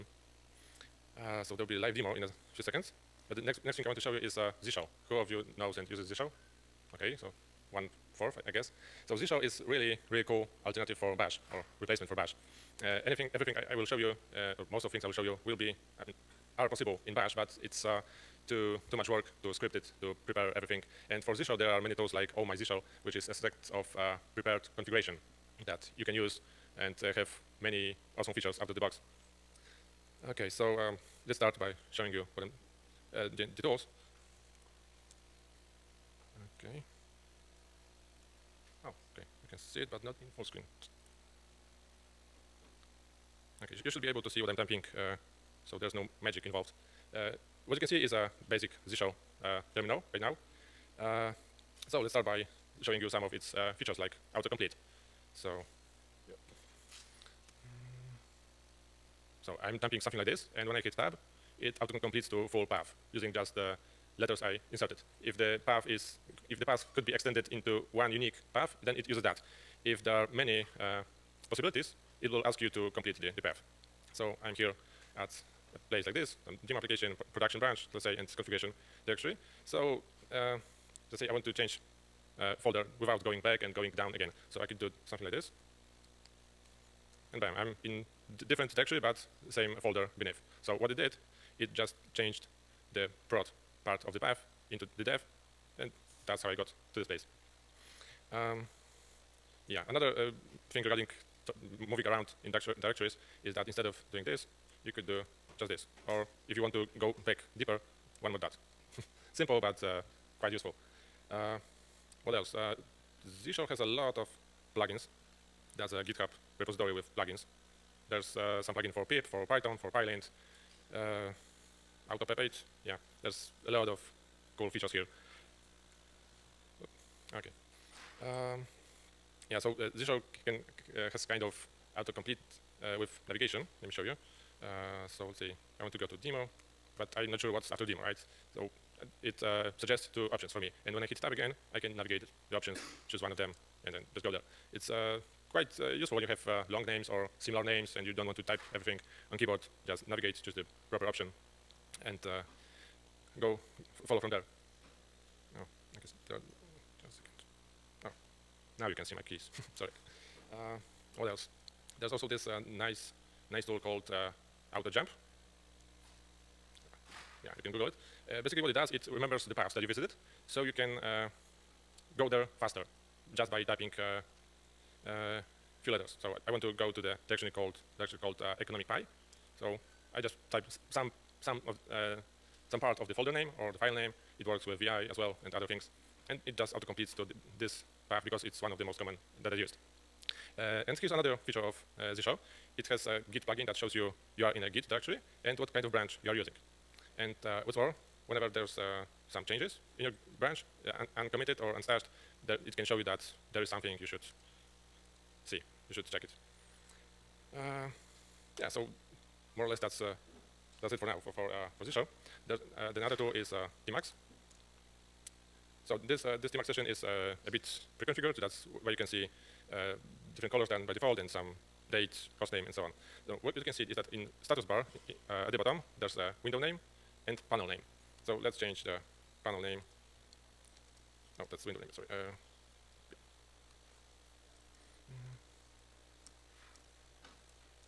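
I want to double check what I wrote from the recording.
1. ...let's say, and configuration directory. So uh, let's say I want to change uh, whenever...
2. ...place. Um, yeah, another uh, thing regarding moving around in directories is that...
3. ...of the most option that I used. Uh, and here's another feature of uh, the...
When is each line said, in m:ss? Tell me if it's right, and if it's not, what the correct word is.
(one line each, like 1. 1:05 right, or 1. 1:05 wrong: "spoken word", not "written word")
1. 1:17 wrong: "folder", not "whenever"
2. 1:37 right
3. 3:08 wrong: "common", not "option".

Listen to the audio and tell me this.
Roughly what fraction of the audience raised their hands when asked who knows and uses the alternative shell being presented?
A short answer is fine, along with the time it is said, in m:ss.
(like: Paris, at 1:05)
one fourth, at 0:07.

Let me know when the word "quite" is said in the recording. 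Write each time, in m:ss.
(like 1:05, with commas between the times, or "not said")
1:50, 2:25.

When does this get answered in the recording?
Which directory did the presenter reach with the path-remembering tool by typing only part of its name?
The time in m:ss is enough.
2:58.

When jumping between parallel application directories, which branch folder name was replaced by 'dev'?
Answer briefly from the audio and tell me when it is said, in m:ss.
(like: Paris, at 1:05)
prod, at 1:33.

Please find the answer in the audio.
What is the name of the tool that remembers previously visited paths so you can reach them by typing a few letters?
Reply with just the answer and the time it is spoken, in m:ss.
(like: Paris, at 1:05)
Auto Jump, at 2:44.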